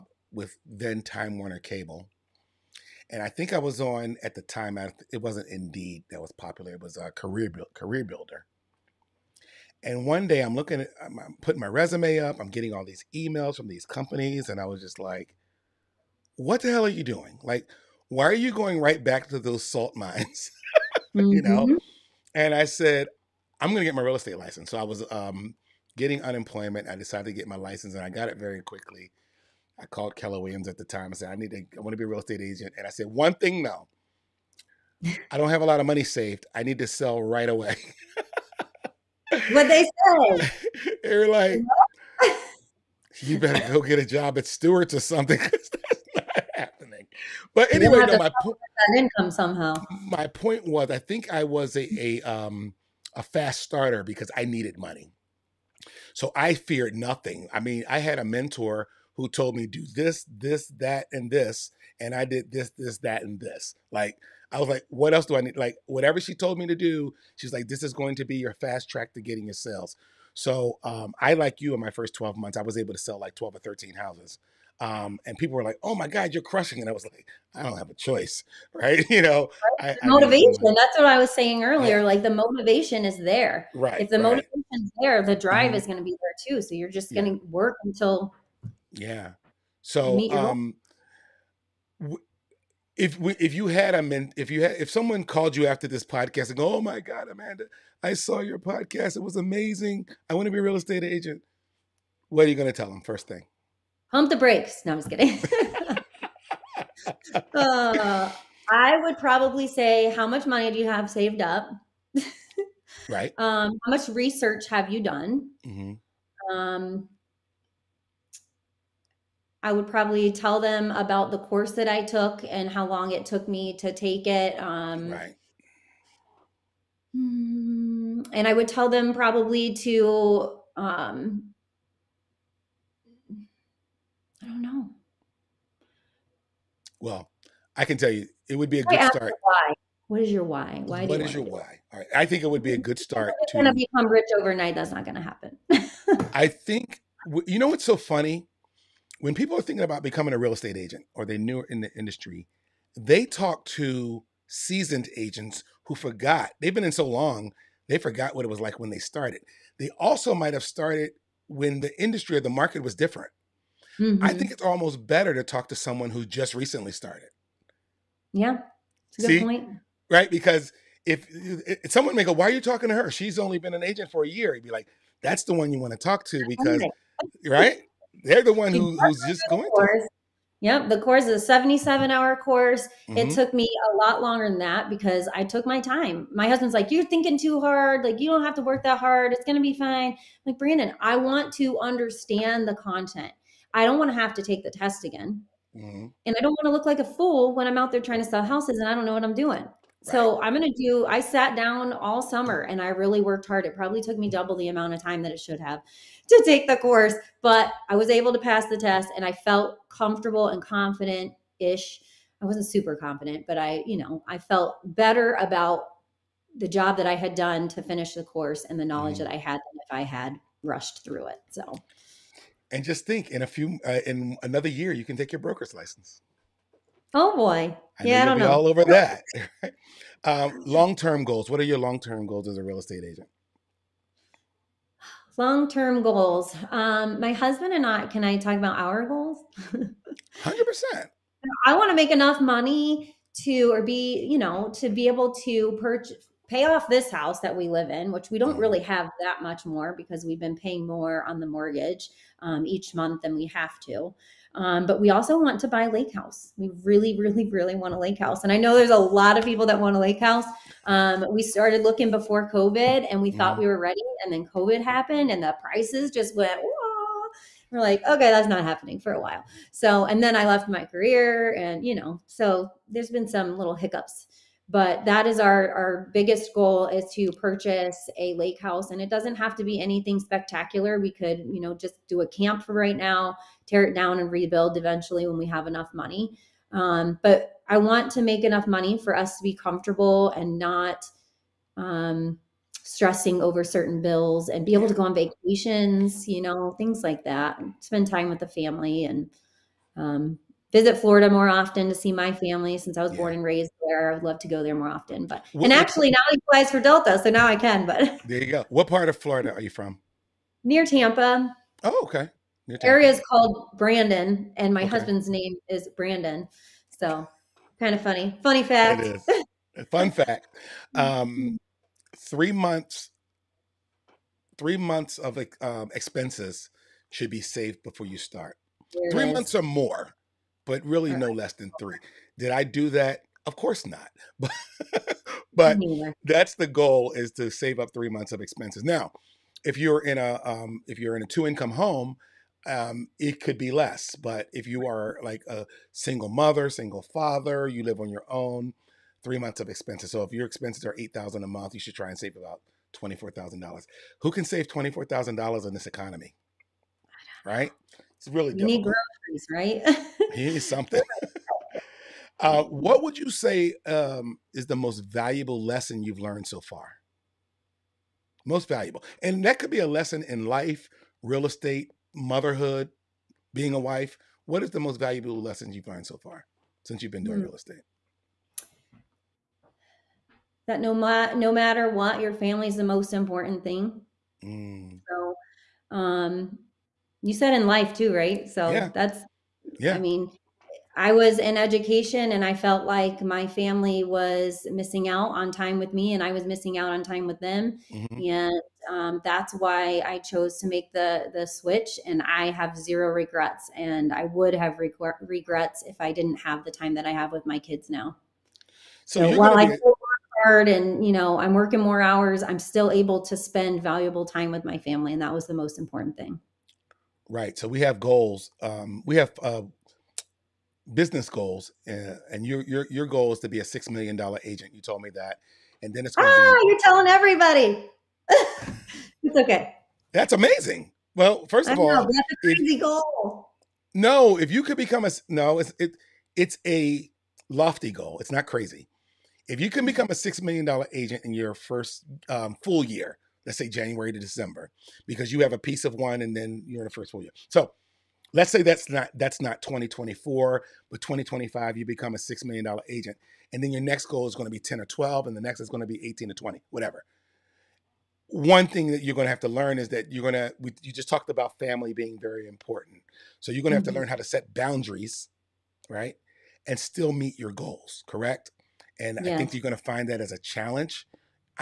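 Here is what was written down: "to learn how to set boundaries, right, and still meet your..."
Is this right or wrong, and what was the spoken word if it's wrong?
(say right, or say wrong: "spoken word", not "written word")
right.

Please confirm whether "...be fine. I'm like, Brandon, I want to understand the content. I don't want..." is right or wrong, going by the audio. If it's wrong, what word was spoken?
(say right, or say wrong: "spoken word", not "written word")
right.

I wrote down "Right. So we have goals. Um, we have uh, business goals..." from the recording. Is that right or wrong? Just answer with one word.
right.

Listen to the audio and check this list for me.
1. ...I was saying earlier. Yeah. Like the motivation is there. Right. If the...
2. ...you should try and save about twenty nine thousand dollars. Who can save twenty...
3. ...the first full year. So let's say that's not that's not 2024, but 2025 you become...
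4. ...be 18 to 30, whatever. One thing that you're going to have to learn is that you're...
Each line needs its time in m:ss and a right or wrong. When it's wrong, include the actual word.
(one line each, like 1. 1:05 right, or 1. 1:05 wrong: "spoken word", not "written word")
1. 1:21 right
2. 5:51 wrong: "four", not "nine"
3. 7:26 right
4. 7:35 wrong: "20", not "30".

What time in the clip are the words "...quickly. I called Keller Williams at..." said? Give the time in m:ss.
0:28.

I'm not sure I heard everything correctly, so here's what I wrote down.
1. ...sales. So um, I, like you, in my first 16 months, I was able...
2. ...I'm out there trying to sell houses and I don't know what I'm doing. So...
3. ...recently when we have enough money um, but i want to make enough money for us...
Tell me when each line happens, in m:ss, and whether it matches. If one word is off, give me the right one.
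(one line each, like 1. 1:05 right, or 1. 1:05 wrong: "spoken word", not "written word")
1. 1:09 wrong: "12", not "16"
2. 3:17 right
3. 4:44 wrong: "eventually", not "recently".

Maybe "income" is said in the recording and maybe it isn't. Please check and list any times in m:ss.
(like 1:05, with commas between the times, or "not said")
0:48, 5:41.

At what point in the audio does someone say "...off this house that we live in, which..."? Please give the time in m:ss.
4:06.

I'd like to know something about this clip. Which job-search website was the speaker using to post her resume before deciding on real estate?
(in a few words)
CareerBuilder.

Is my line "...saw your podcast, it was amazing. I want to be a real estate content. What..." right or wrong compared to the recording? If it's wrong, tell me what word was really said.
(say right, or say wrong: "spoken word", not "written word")
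wrong: "agent", not "content".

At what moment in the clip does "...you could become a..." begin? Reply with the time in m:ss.
7:14.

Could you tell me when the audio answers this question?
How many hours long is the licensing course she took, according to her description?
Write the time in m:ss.
3:01.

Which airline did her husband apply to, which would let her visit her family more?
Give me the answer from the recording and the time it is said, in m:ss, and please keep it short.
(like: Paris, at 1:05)
Delta, at 5:06.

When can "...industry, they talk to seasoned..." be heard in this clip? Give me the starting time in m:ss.
2:31.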